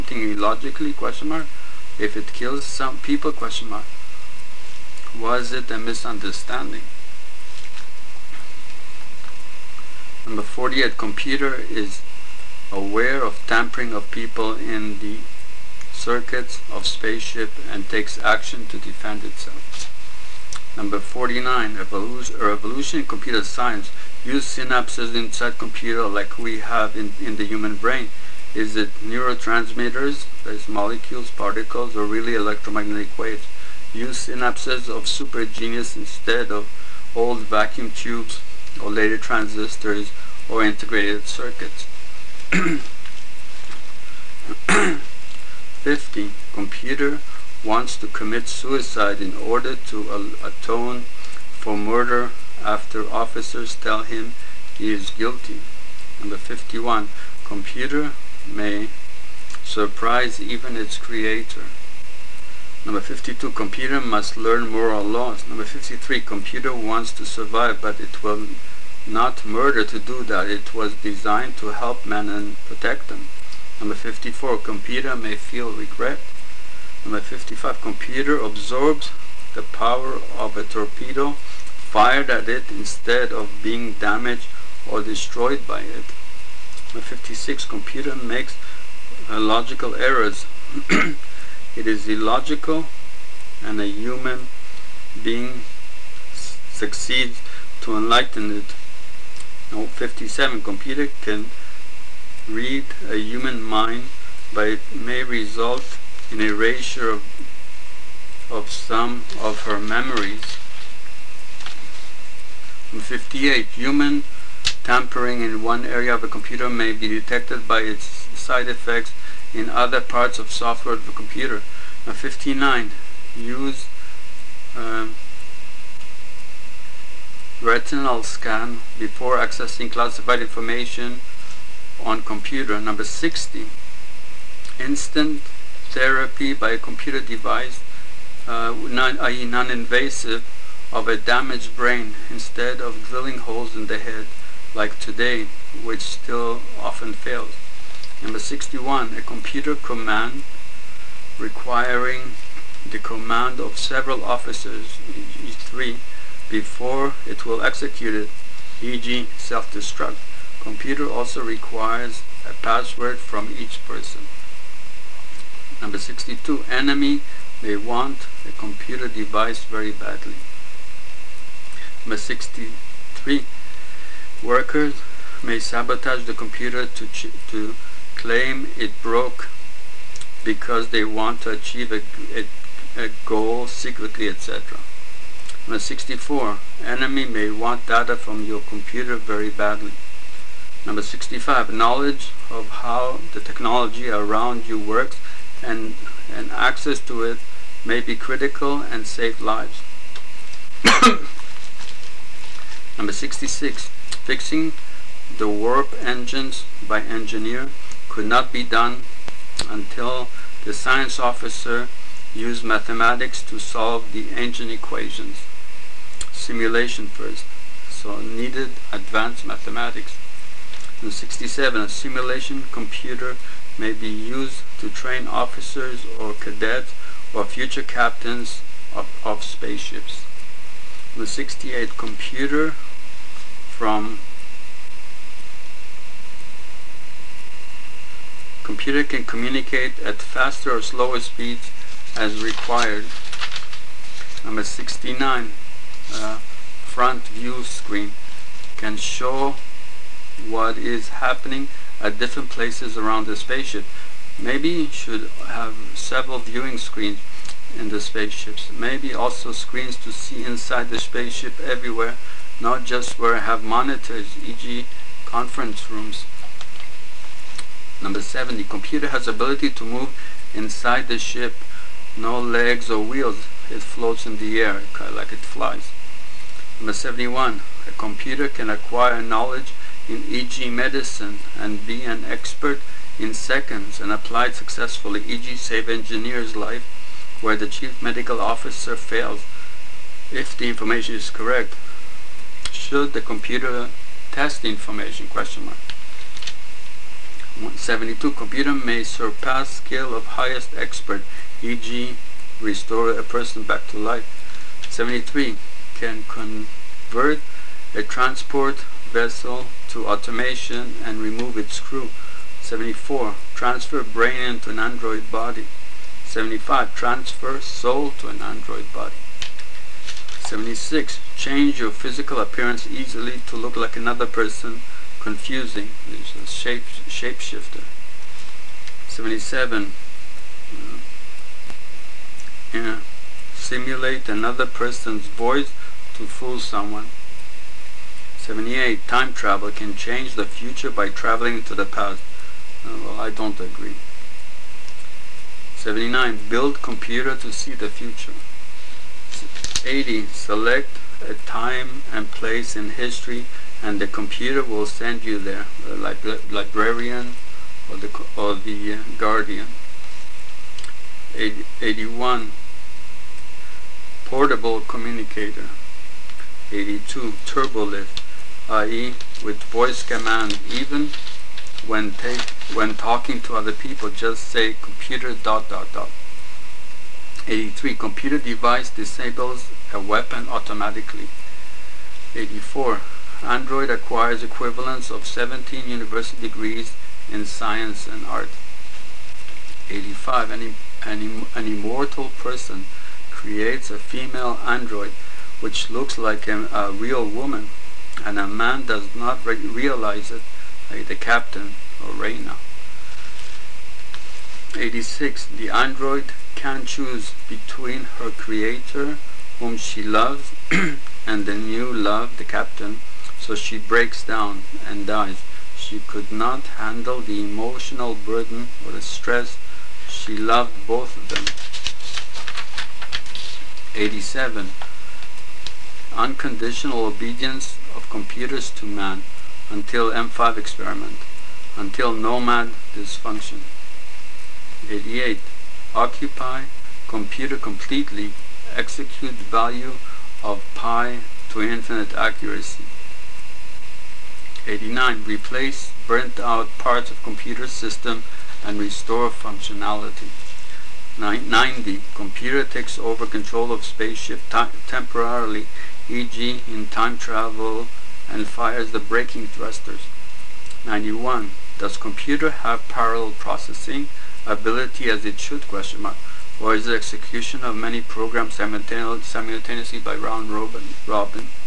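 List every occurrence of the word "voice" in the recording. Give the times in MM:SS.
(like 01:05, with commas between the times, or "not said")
05:35, 06:09.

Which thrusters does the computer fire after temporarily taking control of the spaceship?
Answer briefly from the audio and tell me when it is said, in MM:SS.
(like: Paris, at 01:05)
braking thrusters, at 07:38.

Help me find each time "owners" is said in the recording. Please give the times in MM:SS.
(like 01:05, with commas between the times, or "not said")
not said.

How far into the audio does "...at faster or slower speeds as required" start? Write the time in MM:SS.
04:00.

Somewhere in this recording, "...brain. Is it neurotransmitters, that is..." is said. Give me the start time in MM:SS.
00:27.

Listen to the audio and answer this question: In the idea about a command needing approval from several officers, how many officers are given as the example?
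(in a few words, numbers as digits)
3.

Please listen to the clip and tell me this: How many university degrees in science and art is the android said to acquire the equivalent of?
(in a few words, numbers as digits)
17.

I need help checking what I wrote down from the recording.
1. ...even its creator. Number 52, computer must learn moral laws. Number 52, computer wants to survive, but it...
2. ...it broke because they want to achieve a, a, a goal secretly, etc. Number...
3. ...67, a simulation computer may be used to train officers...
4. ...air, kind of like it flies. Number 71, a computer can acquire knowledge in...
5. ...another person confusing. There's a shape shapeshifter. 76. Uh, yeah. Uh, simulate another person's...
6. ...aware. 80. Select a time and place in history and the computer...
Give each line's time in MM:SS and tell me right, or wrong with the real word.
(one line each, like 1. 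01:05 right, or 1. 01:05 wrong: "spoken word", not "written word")
1. 01:00 wrong: "53", not "52"
2. 02:58 right
3. 03:41 right
4. 04:34 right
5. 05:23 wrong: "77", not "76"
6. 05:47 wrong: "future", not "aware".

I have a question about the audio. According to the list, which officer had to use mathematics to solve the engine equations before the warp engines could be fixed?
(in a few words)
science officer.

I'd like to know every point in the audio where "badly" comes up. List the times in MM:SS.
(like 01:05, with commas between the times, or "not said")
02:49, 03:09.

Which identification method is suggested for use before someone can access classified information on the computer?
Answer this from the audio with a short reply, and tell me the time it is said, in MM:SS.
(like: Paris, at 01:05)
retinal scan, at 02:07.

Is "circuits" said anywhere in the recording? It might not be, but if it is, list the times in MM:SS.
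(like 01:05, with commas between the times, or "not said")
00:15, 00:41.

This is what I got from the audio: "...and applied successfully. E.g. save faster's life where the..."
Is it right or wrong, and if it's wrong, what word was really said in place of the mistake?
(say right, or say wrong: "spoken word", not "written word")
wrong: "engineer", not "faster".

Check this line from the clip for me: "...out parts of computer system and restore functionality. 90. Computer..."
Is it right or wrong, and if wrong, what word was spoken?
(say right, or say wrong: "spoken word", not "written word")
right.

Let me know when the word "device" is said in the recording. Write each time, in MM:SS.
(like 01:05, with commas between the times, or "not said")
02:17, 02:49, 06:18.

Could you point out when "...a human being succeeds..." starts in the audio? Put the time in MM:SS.
01:33.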